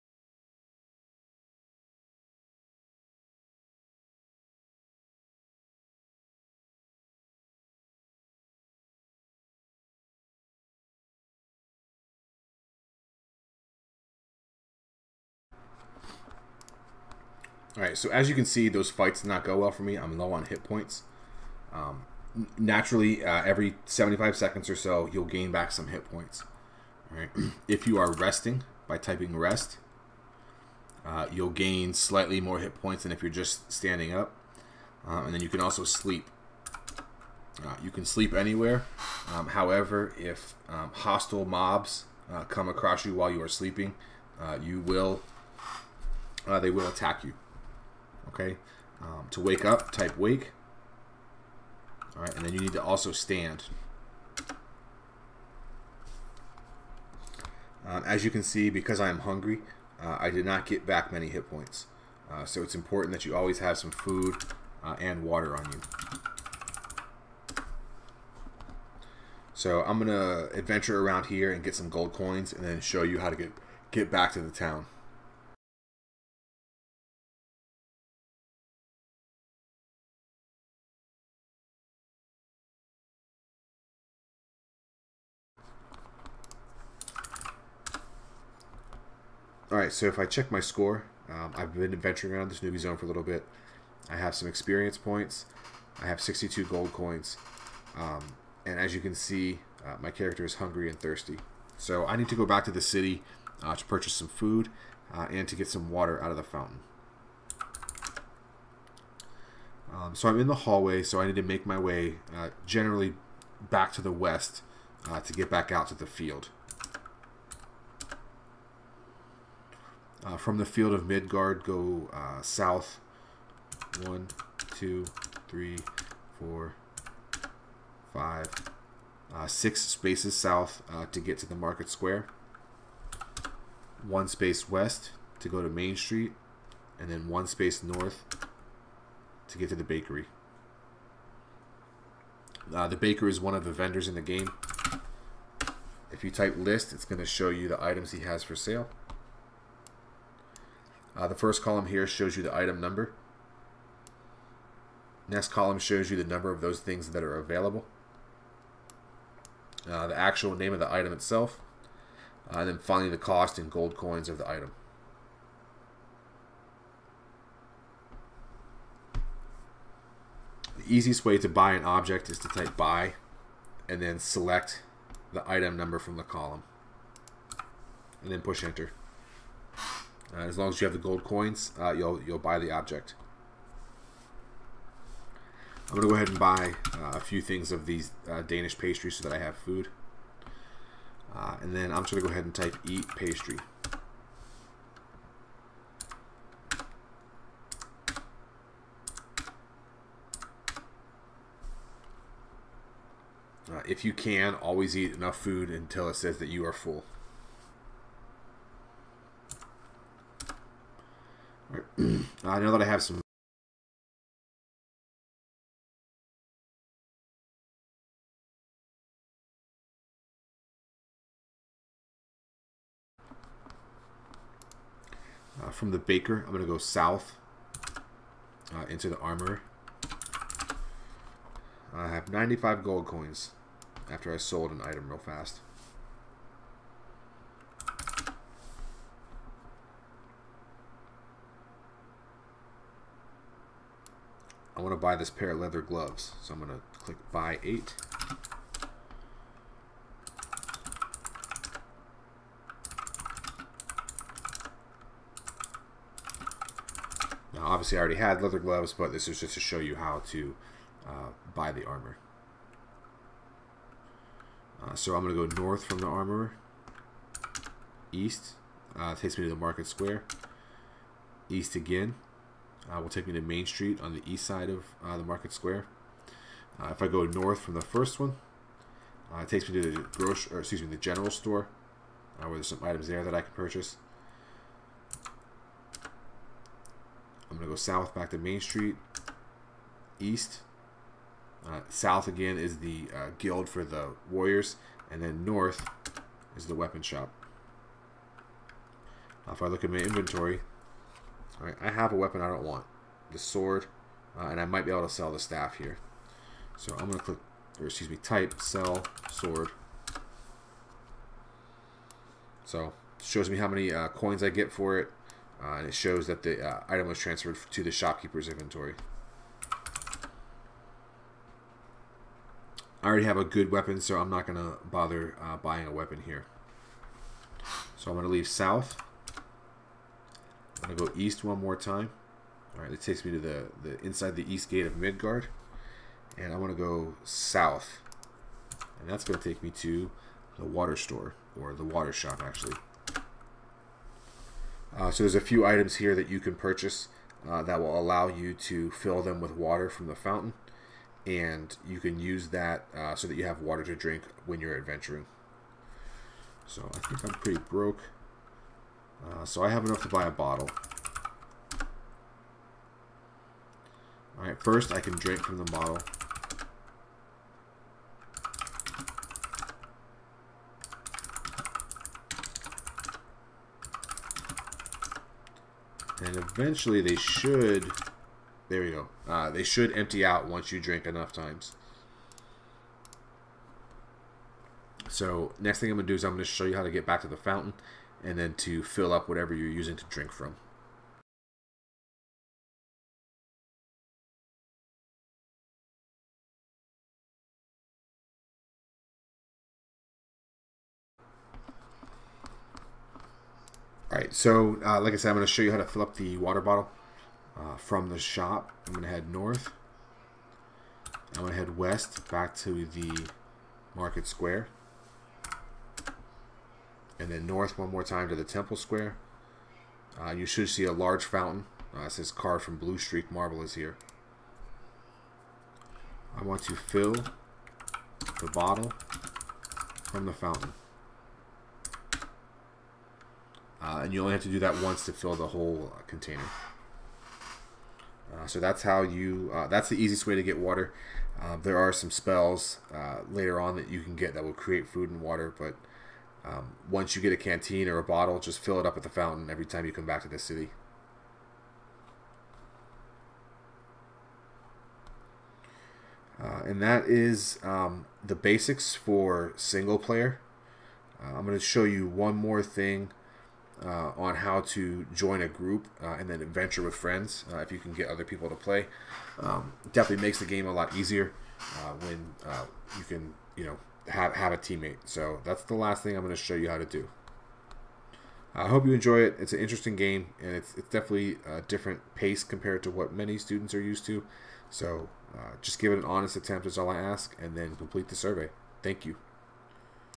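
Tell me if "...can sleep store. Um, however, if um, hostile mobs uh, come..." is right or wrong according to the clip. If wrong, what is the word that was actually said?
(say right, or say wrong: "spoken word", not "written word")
wrong: "anywhere", not "store".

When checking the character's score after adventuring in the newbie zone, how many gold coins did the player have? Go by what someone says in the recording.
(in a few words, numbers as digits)
62.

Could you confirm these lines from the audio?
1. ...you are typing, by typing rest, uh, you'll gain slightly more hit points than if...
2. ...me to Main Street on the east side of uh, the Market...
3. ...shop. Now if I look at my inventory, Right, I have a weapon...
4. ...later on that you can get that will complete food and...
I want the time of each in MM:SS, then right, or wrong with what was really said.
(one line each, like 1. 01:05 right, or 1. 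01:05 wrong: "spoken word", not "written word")
1. 00:27 wrong: "resting", not "typing"
2. 04:33 right
3. 04:57 right
4. 07:23 wrong: "create", not "complete".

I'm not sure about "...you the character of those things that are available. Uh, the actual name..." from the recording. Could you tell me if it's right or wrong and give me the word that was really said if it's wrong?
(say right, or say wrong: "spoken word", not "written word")
wrong: "number", not "character".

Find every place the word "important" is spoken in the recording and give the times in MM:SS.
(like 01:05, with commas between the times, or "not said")
01:02.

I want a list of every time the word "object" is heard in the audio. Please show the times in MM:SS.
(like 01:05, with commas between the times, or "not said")
02:51, 03:02.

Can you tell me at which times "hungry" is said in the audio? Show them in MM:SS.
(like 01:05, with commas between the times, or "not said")
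00:59, 01:40.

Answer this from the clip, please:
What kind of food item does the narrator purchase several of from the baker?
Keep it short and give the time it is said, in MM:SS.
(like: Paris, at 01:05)
Danish pastries, at 03:08.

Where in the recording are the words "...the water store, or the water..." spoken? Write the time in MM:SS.
05:40.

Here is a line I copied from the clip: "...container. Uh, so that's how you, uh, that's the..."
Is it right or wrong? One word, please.
right.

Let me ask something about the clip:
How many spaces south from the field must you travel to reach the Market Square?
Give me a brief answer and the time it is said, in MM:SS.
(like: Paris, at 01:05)
6, at 02:09.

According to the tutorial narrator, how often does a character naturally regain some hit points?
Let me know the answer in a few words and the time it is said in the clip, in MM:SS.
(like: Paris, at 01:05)
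75 seconds, at 00:23.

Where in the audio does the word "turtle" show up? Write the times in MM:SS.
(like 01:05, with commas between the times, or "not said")
not said.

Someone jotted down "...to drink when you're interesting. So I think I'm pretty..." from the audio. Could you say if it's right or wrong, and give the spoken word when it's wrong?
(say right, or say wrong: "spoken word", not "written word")
wrong: "adventuring", not "interesting".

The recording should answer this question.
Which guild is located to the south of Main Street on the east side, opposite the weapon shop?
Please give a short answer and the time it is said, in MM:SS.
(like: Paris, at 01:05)
warriors, at 04:52.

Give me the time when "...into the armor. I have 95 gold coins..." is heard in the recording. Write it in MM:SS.
03:48.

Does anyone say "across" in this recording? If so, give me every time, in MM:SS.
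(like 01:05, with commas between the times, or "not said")
00:42.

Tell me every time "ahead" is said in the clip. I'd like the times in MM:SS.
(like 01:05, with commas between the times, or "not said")
03:06, 03:12.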